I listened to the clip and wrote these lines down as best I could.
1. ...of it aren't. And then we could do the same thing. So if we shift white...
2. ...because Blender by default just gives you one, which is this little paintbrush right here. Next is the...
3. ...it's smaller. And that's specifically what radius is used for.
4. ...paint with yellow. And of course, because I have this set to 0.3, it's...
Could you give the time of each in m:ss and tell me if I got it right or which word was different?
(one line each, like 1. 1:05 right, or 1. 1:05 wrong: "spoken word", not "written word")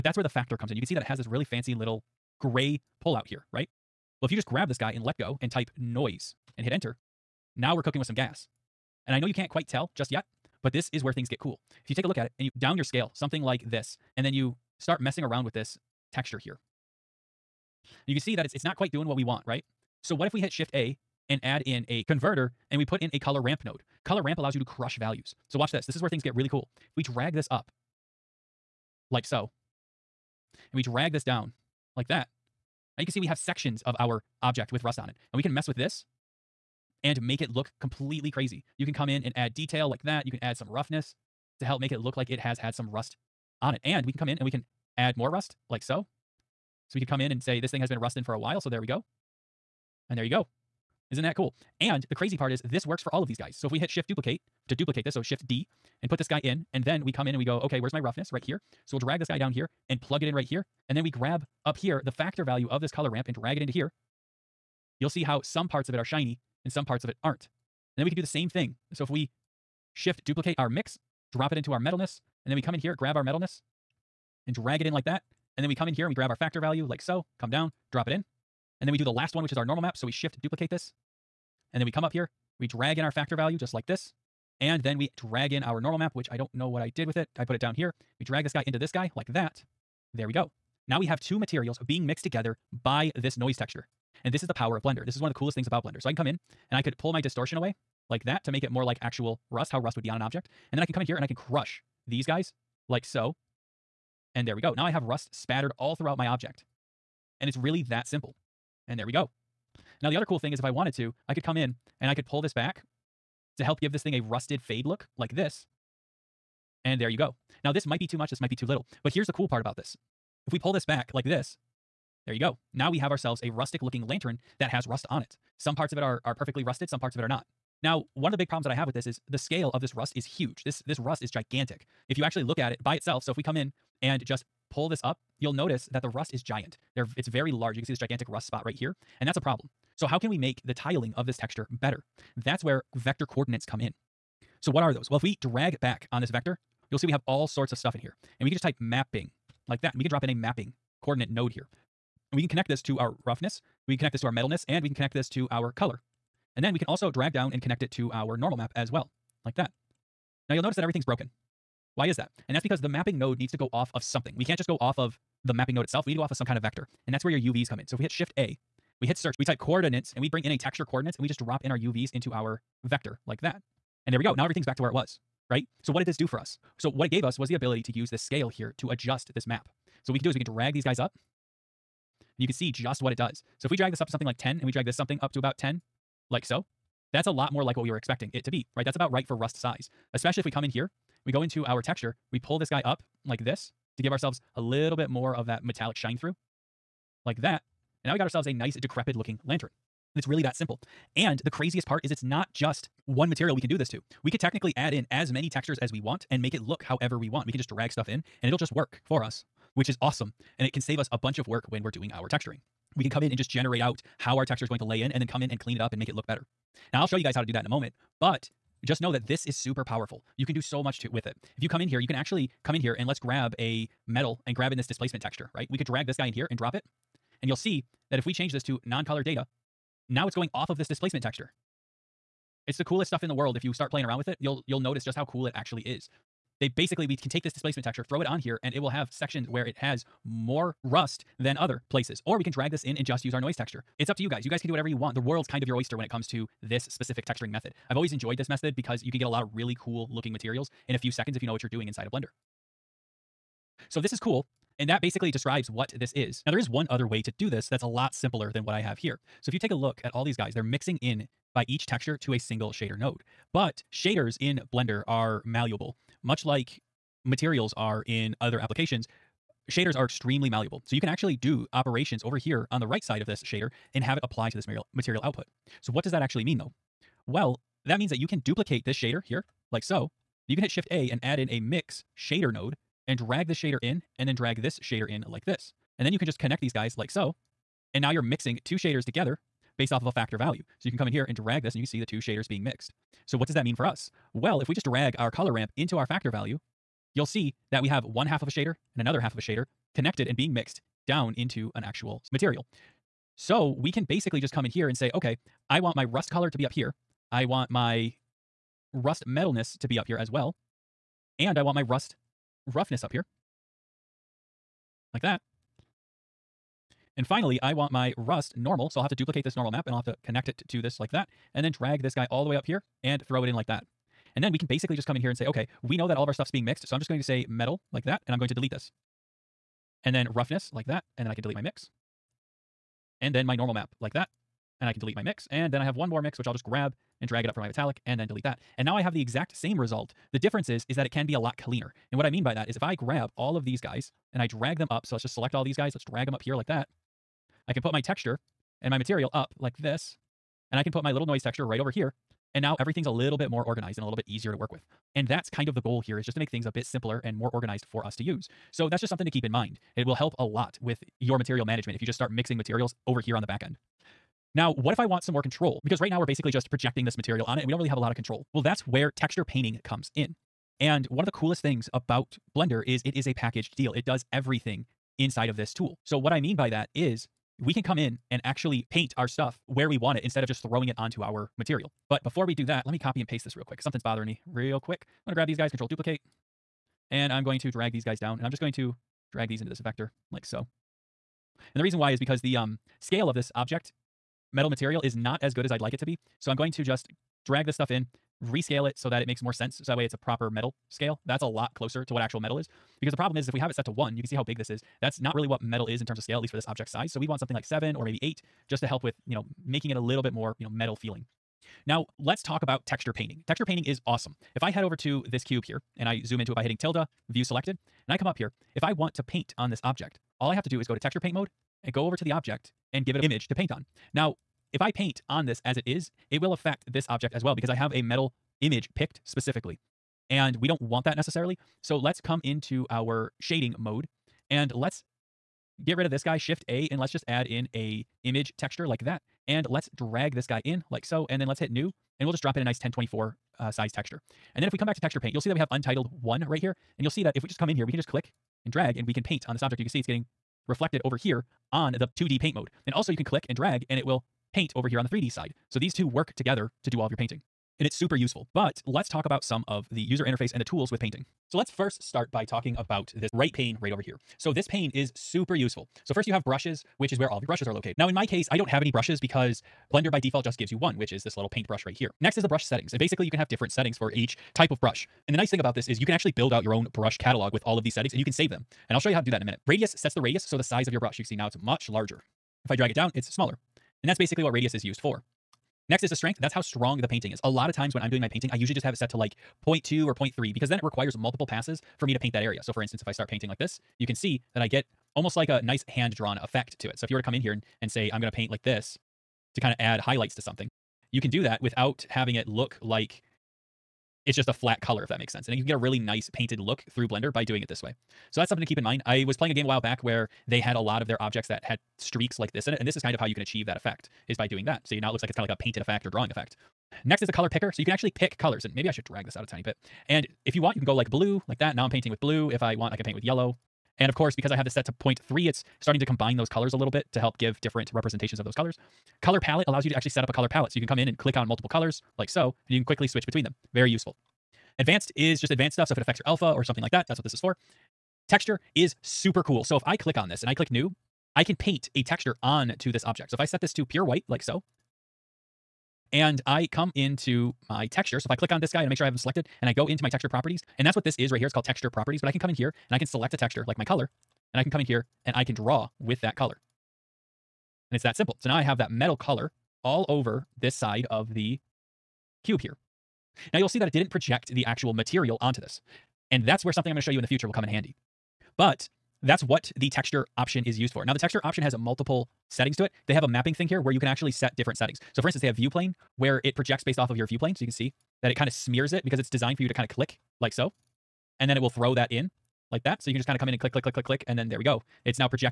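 1. 1:07 wrong: "duplicate", not "white"
2. 7:49 right
3. 8:03 wrong: "basically", not "specifically"
4. 8:43 right.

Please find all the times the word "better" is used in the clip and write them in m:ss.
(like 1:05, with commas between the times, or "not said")
2:21, 3:36.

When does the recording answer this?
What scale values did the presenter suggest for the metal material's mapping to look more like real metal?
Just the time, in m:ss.
6:47.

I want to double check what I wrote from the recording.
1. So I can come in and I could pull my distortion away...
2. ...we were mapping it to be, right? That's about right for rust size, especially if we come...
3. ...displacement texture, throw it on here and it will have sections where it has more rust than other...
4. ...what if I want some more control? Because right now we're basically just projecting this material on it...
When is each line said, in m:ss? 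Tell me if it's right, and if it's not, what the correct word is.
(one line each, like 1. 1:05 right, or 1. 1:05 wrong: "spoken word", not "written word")
1. 1:36 right
2. 3:07 wrong: "expecting", not "mapping"
3. 3:57 right
4. 6:04 right.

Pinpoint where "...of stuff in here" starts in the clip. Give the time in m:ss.
2:27.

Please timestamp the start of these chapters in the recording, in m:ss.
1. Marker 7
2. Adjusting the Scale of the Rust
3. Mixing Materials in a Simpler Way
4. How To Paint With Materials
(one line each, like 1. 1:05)
1. 1:52
2. 2:06
3. 4:22
4. 6:03.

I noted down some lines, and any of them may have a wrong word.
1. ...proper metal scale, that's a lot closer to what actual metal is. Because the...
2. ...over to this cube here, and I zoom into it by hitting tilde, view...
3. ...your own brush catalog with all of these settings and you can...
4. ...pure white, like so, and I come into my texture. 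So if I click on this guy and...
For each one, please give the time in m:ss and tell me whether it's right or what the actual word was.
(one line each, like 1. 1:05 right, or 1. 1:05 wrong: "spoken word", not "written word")
1. 6:40 right
2. 6:54 right
3. 7:56 right
4. 9:03 right.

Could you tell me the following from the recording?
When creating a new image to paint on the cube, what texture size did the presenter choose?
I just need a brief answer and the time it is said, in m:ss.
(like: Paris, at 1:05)
1024, at 7:22.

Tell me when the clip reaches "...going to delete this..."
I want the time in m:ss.
5:28.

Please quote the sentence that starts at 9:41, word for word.
And then it will throw that in like that.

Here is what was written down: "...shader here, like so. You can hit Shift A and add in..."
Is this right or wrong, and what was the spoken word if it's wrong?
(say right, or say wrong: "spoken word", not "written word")
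right.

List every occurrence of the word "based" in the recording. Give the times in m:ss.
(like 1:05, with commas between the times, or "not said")
4:49, 9:36.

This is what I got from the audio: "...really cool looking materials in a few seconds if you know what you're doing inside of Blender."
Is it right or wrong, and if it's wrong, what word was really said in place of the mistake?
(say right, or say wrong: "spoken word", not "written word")
right.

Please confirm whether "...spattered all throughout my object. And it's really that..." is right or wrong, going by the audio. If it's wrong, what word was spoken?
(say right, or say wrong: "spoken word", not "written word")
right.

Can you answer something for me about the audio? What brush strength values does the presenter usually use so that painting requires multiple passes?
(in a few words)
0.2 or 0.3.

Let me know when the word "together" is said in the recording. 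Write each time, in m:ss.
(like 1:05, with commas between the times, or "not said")
1:32, 4:49, 7:36.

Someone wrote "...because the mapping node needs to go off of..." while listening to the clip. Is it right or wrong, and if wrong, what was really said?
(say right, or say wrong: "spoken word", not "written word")
right.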